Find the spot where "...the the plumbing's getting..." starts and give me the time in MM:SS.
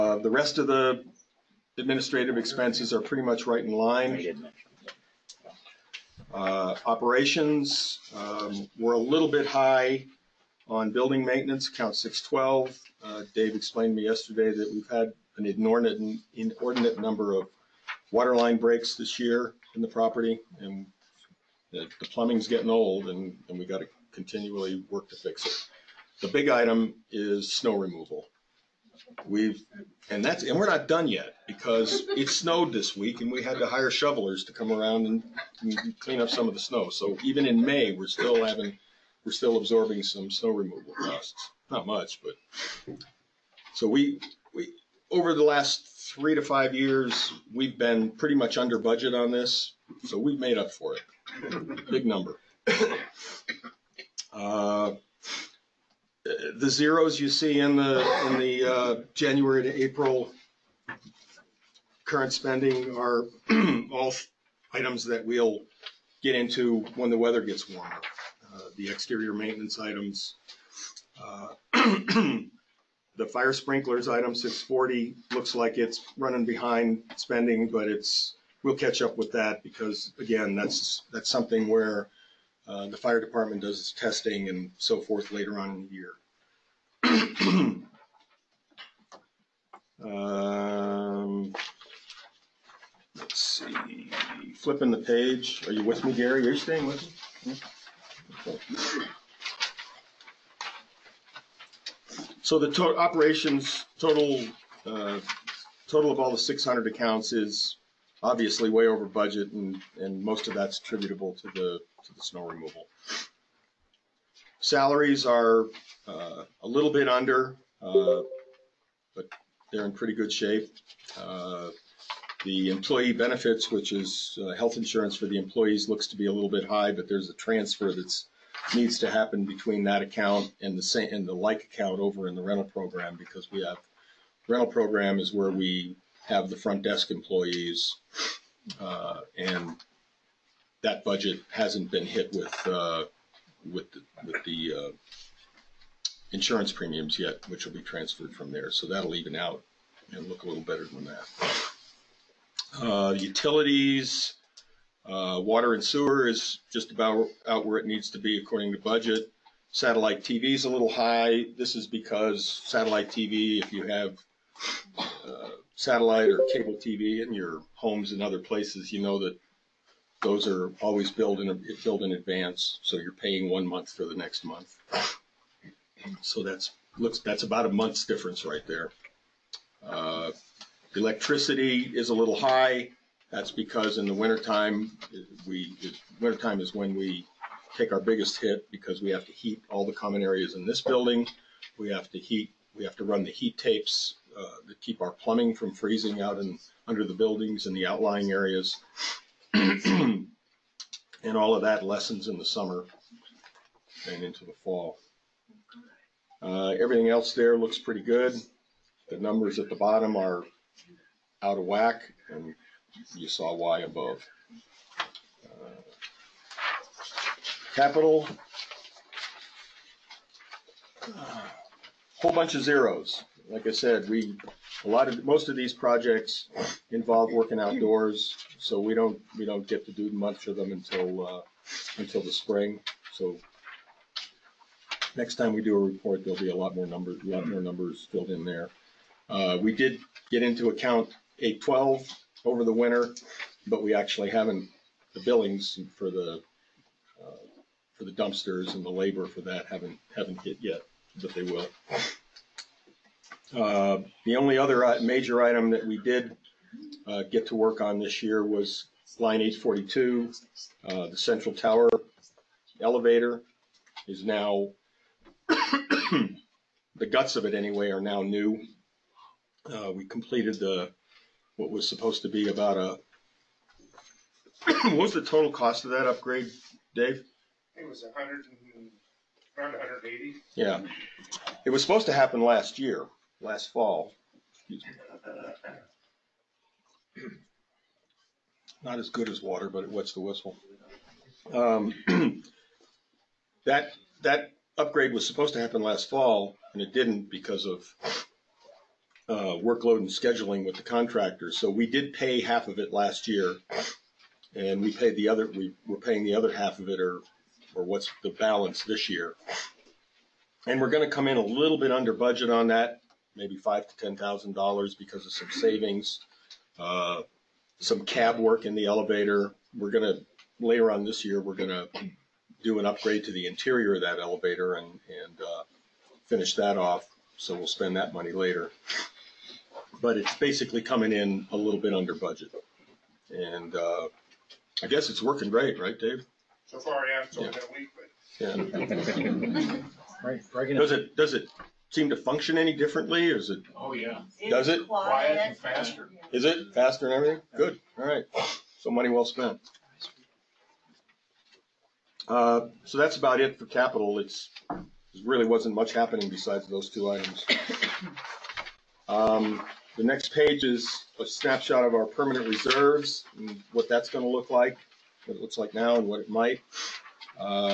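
00:21.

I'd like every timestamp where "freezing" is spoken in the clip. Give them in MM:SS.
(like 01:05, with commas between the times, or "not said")
03:15.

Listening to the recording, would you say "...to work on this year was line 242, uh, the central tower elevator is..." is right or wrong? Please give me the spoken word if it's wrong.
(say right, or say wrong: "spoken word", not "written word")
wrong: "842", not "242".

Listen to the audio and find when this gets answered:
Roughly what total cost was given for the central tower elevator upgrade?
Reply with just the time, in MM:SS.
04:39.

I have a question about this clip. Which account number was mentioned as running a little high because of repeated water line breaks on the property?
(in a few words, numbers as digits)
612.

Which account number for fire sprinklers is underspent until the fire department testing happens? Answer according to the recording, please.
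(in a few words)
640.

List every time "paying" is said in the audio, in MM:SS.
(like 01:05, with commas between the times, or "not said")
02:53, 05:06.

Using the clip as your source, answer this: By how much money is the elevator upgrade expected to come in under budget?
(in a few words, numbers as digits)
5,000 to 10,000 dollars.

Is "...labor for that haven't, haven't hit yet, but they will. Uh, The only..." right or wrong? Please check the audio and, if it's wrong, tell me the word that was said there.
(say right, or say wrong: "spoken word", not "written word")
right.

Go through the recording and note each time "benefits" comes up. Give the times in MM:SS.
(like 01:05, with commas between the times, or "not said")
02:03.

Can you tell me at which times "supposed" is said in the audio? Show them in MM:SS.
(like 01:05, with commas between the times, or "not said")
04:31, 04:41, 04:55.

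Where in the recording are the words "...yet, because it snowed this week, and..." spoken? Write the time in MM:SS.
00:31.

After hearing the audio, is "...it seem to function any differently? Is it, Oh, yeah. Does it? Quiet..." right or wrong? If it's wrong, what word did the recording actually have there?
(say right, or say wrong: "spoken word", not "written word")
right.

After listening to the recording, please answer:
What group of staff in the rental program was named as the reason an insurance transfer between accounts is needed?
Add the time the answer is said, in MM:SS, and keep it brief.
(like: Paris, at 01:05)
front desk employees, at 02:16.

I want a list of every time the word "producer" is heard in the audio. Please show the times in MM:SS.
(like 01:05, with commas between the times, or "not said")
not said.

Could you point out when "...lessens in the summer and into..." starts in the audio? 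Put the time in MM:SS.
03:21.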